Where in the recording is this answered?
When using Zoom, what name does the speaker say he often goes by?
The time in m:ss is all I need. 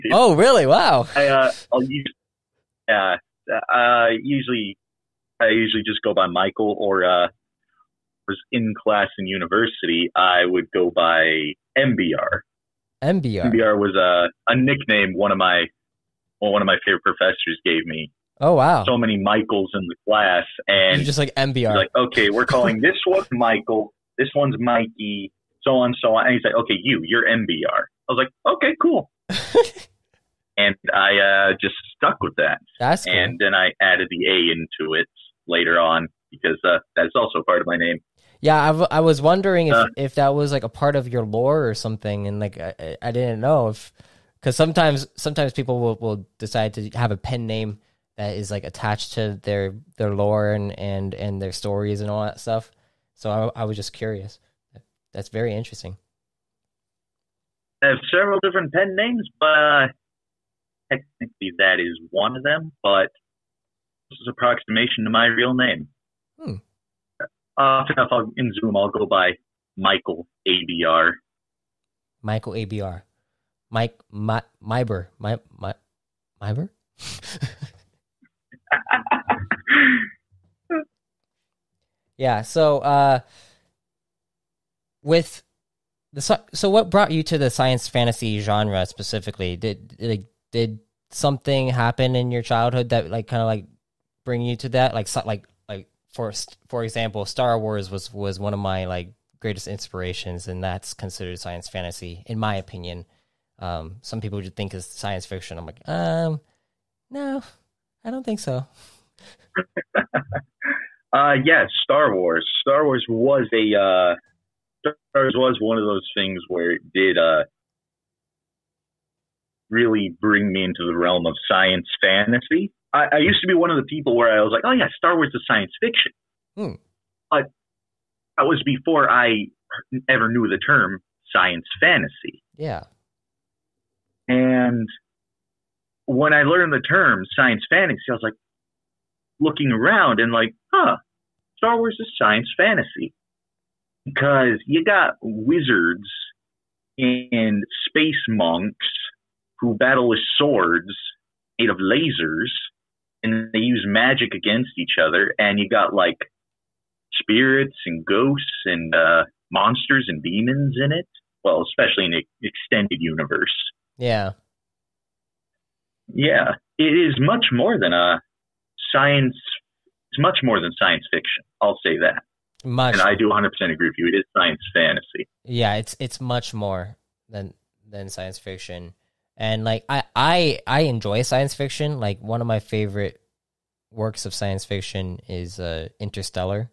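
1:08.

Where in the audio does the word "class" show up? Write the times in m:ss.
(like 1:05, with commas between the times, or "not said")
0:08, 0:20.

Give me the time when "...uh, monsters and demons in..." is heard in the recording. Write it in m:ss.
2:38.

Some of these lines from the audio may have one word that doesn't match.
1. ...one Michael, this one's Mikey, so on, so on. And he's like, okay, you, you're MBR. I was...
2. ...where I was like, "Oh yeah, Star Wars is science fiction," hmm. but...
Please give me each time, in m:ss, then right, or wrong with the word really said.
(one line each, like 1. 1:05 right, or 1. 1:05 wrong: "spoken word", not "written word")
1. 0:23 right
2. 2:04 right.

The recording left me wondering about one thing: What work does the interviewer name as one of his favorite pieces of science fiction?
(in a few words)
Interstellar.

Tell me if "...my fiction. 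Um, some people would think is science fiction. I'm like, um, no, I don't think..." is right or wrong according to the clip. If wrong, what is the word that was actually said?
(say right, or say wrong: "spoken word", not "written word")
wrong: "opinion", not "fiction".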